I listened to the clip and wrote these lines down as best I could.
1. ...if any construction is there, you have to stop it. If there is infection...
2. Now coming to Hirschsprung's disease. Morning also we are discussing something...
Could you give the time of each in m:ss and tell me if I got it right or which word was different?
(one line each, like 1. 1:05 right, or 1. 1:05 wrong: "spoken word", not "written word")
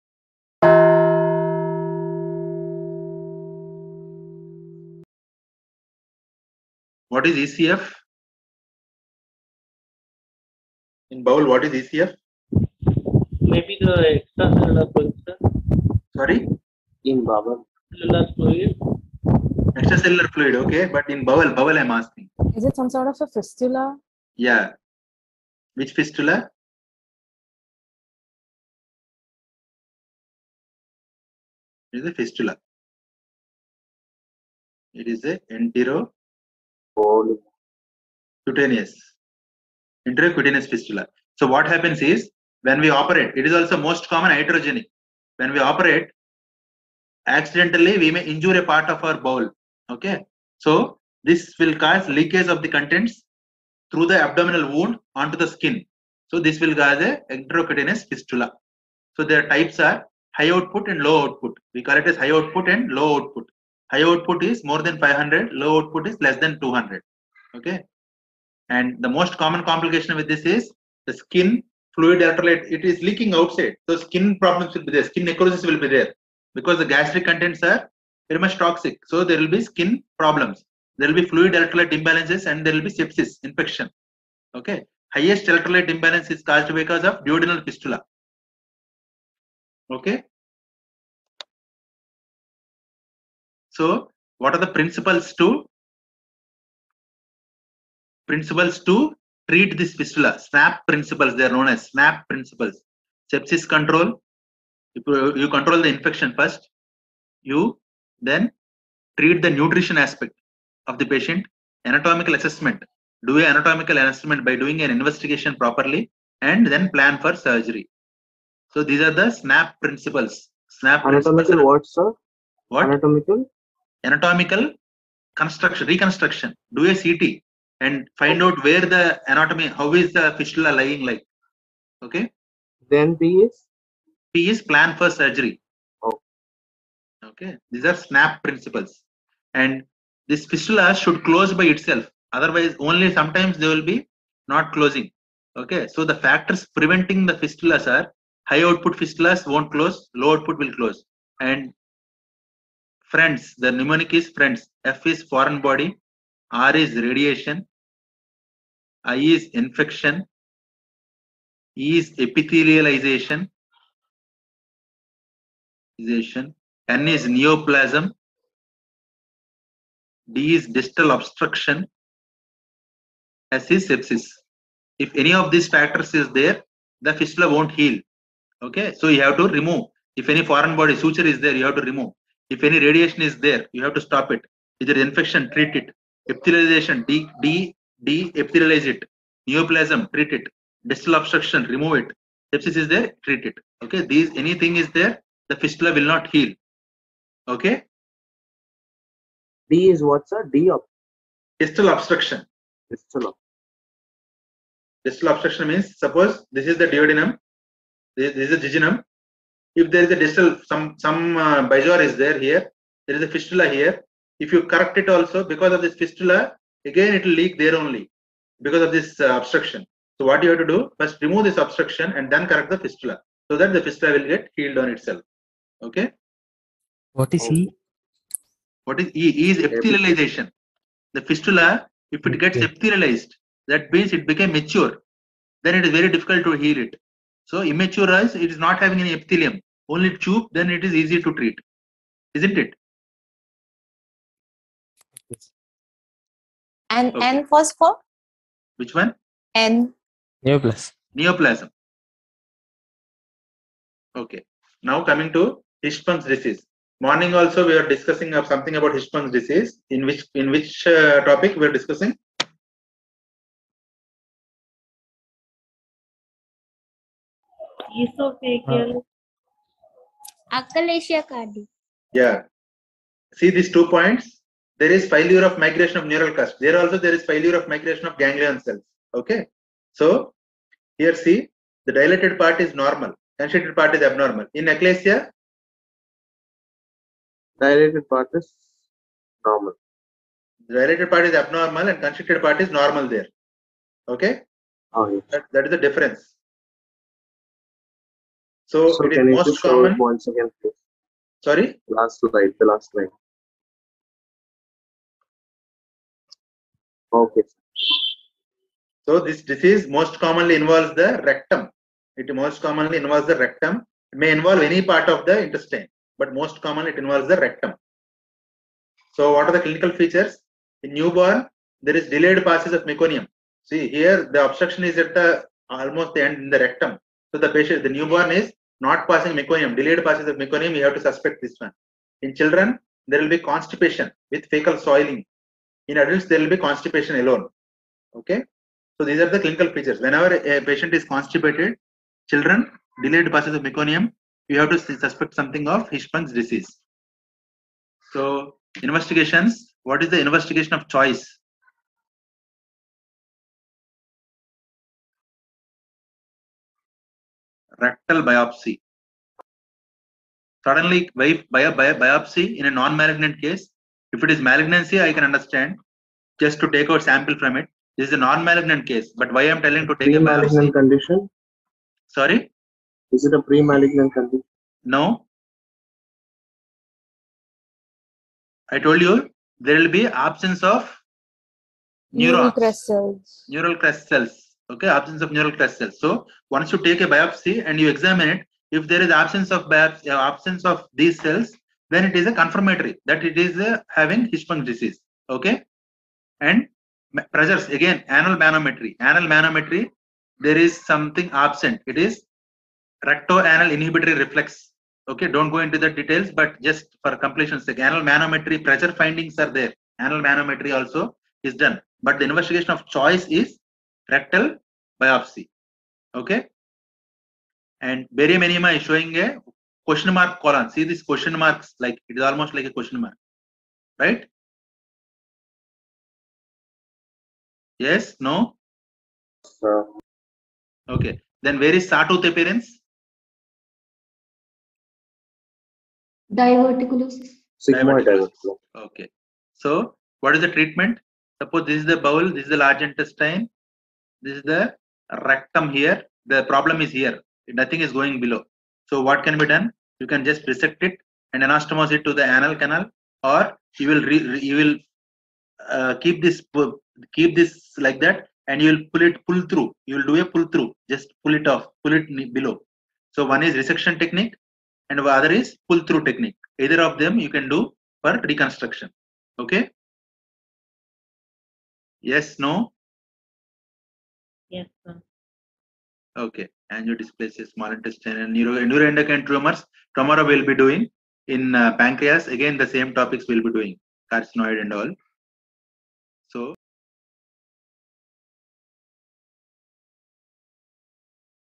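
1. 3:02 wrong: "radiation", not "construction"
2. 4:14 right.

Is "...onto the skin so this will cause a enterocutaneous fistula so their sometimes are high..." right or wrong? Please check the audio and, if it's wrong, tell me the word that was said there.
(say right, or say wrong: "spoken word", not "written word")
wrong: "types", not "sometimes".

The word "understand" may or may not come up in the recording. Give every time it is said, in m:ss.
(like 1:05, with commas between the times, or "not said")
6:05.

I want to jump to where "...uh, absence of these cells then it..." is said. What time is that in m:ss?
6:30.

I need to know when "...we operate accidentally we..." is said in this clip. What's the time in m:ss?
0:45.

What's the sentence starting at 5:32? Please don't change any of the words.
In children, there will be constipation with fecal soiling.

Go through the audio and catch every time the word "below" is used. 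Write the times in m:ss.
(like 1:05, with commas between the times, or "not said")
7:28, 7:42.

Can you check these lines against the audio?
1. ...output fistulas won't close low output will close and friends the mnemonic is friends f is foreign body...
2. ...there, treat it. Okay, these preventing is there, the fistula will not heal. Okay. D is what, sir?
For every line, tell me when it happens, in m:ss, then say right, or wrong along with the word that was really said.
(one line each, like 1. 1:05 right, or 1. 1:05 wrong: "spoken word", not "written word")
1. 2:28 right
2. 3:12 wrong: "anything", not "preventing".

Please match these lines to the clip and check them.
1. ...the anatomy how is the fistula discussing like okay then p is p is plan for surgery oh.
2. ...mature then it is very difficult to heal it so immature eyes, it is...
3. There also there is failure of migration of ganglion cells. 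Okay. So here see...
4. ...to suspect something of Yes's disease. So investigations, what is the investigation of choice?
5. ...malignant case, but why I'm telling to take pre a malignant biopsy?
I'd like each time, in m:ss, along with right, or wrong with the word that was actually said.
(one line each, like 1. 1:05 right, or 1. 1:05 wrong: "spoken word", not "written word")
1. 2:08 wrong: "lying", not "discussing"
2. 3:54 right
3. 4:36 right
4. 5:44 wrong: "Hirschsprung", not "Yes"
5. 6:08 right.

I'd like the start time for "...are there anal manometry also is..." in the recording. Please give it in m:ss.
6:49.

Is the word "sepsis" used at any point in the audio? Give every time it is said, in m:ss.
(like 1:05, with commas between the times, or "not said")
1:22, 1:43, 2:53, 3:12.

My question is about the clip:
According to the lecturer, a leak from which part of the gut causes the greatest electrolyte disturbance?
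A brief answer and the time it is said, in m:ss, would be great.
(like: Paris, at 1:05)
duodenal fistula, at 1:27.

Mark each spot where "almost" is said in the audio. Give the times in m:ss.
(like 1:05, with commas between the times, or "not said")
5:25, 7:02.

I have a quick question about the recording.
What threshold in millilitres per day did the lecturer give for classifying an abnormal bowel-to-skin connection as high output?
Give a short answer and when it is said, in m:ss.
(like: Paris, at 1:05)
more than 500, at 1:03.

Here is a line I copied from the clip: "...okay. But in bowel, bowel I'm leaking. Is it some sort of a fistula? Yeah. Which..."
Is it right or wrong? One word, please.
wrong.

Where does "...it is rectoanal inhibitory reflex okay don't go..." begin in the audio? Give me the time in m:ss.
6:41.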